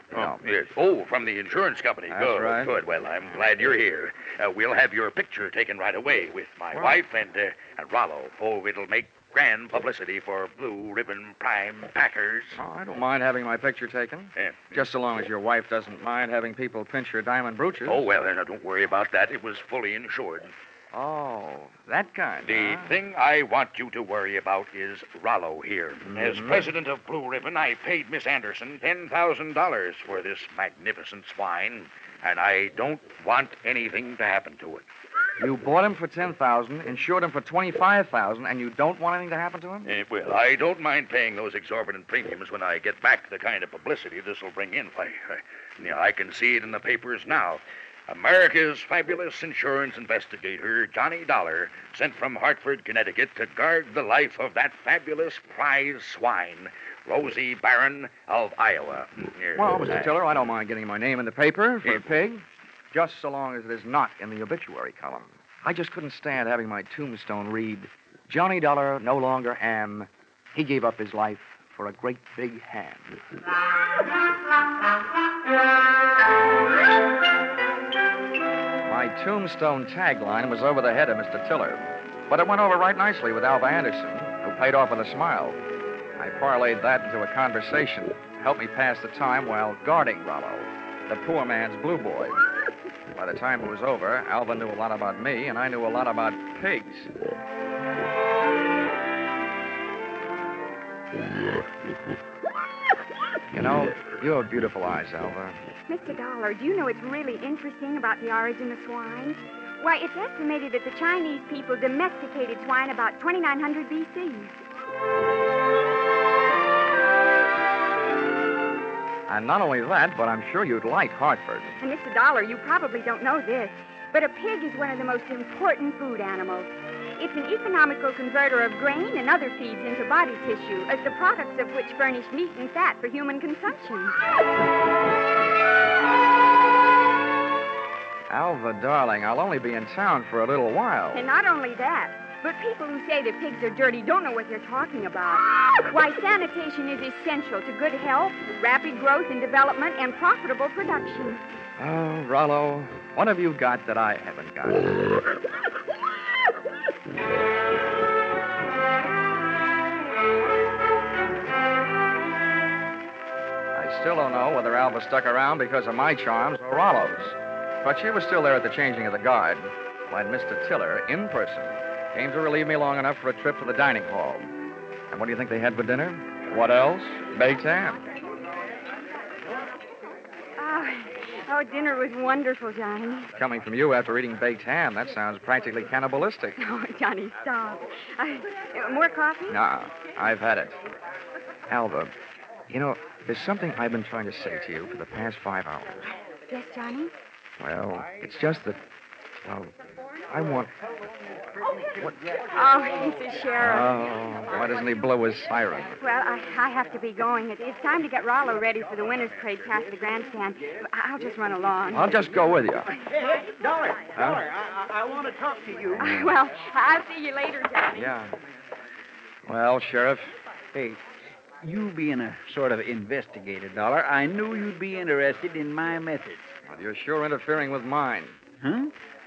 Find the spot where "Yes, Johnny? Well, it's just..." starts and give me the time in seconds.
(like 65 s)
196 s.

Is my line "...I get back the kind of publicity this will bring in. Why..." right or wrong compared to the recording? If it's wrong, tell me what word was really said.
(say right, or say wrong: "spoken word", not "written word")
right.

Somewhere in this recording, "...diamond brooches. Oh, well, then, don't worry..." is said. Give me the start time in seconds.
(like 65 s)
17 s.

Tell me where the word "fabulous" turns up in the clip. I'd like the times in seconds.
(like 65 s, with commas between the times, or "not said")
48 s, 54 s.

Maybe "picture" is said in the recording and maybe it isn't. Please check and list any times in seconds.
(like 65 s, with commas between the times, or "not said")
5 s, 13 s.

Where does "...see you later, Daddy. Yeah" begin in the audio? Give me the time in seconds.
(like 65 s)
217 s.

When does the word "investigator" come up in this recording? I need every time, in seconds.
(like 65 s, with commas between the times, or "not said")
49 s, 222 s.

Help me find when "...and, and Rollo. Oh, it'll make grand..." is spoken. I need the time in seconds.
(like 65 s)
7 s.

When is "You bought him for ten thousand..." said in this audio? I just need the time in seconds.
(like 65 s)
35 s.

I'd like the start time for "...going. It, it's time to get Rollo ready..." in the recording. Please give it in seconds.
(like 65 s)
207 s.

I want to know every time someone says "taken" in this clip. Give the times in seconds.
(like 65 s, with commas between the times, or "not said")
5 s, 13 s.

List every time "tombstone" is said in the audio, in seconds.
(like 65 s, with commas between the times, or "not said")
66 s, 79 s.